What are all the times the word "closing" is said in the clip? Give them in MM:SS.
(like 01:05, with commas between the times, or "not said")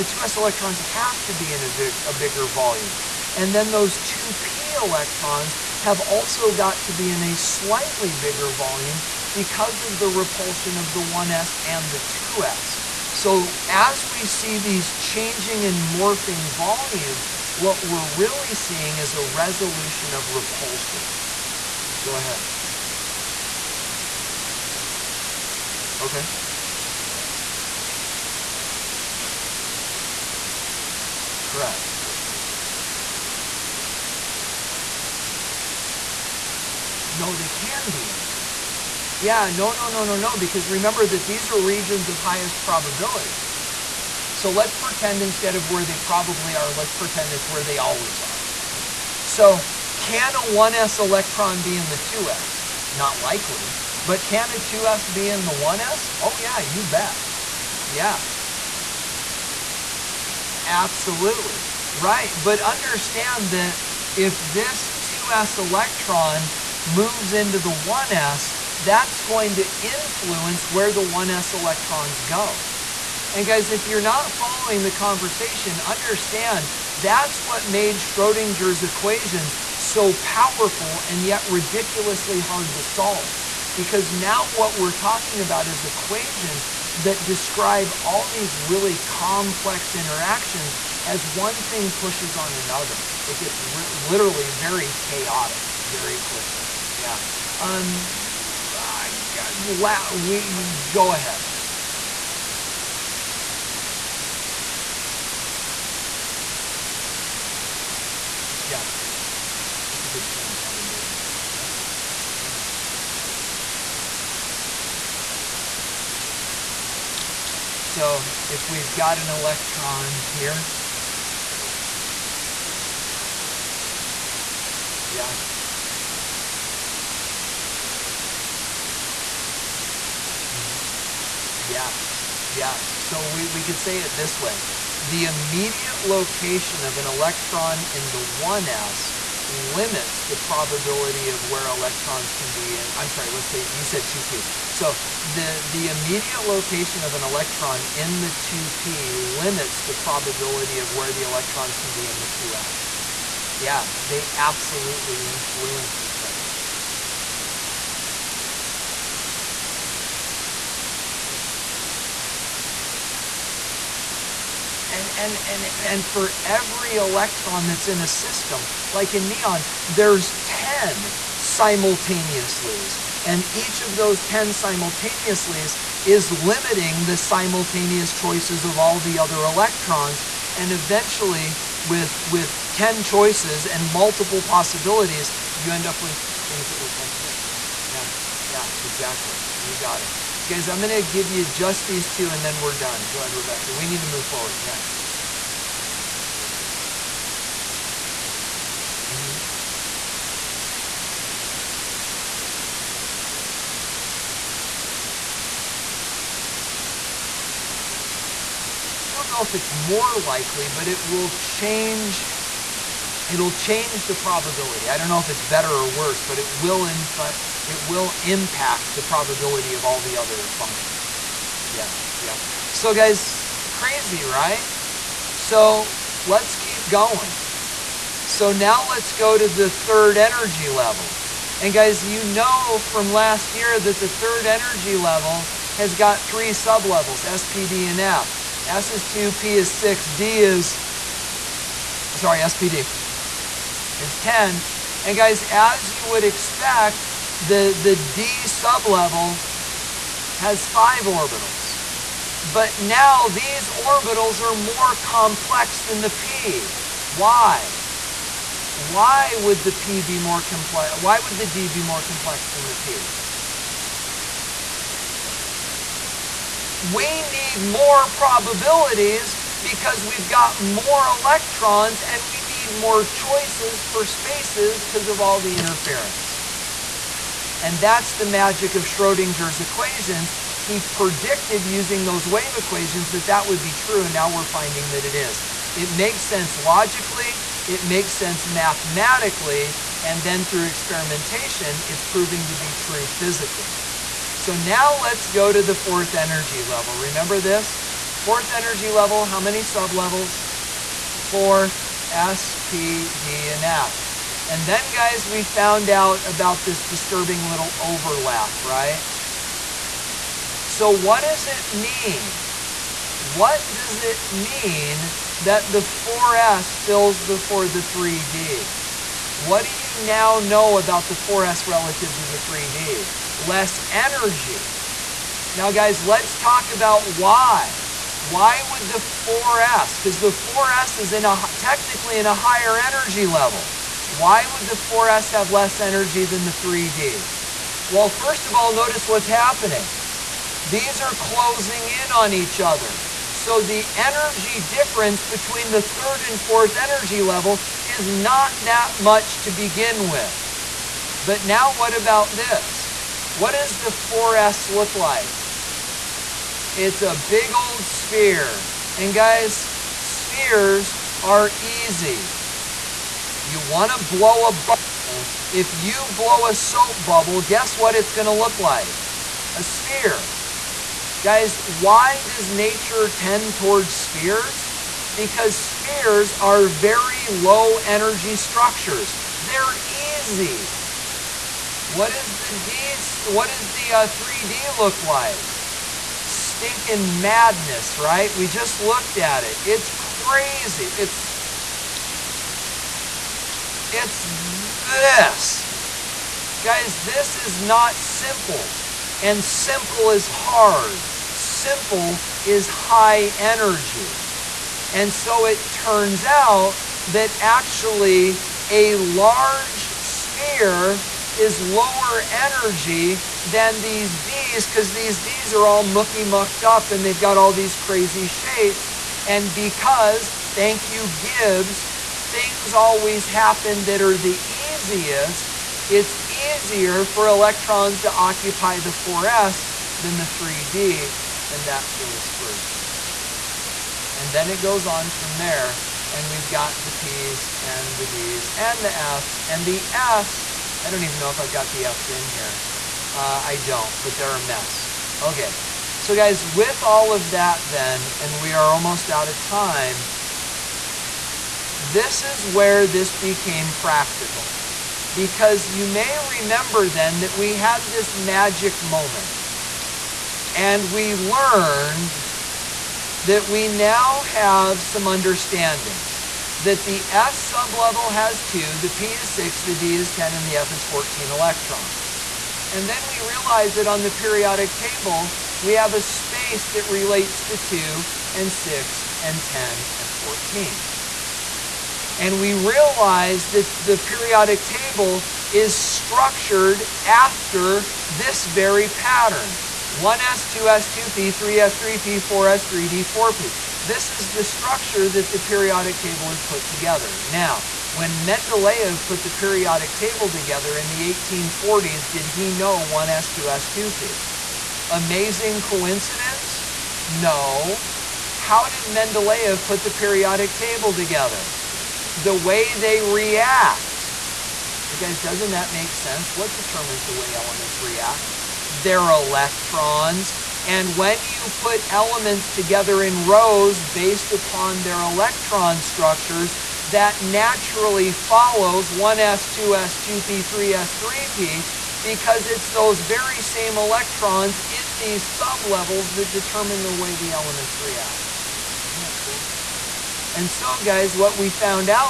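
05:41.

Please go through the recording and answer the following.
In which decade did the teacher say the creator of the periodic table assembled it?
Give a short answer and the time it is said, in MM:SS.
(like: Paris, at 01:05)
1840s, at 08:21.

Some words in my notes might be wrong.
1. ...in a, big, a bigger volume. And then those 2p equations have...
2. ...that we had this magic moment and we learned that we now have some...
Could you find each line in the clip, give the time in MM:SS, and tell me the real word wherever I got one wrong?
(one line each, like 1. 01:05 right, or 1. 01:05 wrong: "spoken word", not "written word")
1. 00:01 wrong: "electrons", not "equations"
2. 07:37 right.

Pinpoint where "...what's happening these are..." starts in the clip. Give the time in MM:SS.
05:39.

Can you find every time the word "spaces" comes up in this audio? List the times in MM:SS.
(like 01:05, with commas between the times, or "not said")
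04:34, 07:56.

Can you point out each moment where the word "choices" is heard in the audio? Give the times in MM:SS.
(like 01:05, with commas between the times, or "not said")
02:58, 03:03, 04:33.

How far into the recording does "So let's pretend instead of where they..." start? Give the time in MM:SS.
00:44.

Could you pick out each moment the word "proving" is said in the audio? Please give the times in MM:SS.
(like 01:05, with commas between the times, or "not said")
04:52.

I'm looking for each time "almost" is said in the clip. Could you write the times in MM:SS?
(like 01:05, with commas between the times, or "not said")
07:28.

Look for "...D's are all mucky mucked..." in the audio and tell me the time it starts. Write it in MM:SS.
06:55.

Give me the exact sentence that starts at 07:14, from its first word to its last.
And then it goes on from there, and we've got the p's and the d's and the f's.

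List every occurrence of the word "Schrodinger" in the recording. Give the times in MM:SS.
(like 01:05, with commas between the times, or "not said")
01:17, 04:38.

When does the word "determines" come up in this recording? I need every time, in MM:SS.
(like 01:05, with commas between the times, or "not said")
08:36, 08:56.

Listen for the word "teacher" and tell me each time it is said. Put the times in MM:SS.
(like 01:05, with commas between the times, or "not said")
not said.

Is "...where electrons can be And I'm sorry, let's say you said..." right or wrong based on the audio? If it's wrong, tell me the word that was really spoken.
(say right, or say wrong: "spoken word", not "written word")
right.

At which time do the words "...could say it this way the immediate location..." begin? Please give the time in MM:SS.
02:13.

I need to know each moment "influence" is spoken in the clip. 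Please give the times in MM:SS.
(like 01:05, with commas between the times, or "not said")
01:09, 02:35.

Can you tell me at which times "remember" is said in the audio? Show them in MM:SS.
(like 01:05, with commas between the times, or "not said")
00:40, 04:56, 07:36.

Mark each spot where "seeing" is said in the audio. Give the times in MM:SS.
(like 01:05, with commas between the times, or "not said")
00:18.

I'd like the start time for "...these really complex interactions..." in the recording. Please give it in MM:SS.
01:28.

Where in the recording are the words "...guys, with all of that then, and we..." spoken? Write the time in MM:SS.
07:26.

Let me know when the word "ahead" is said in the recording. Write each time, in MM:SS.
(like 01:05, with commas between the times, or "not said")
00:22, 01:41.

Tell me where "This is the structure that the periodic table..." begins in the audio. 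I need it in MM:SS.
08:13.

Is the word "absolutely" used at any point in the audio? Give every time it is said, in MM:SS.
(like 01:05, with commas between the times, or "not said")
01:00, 02:34.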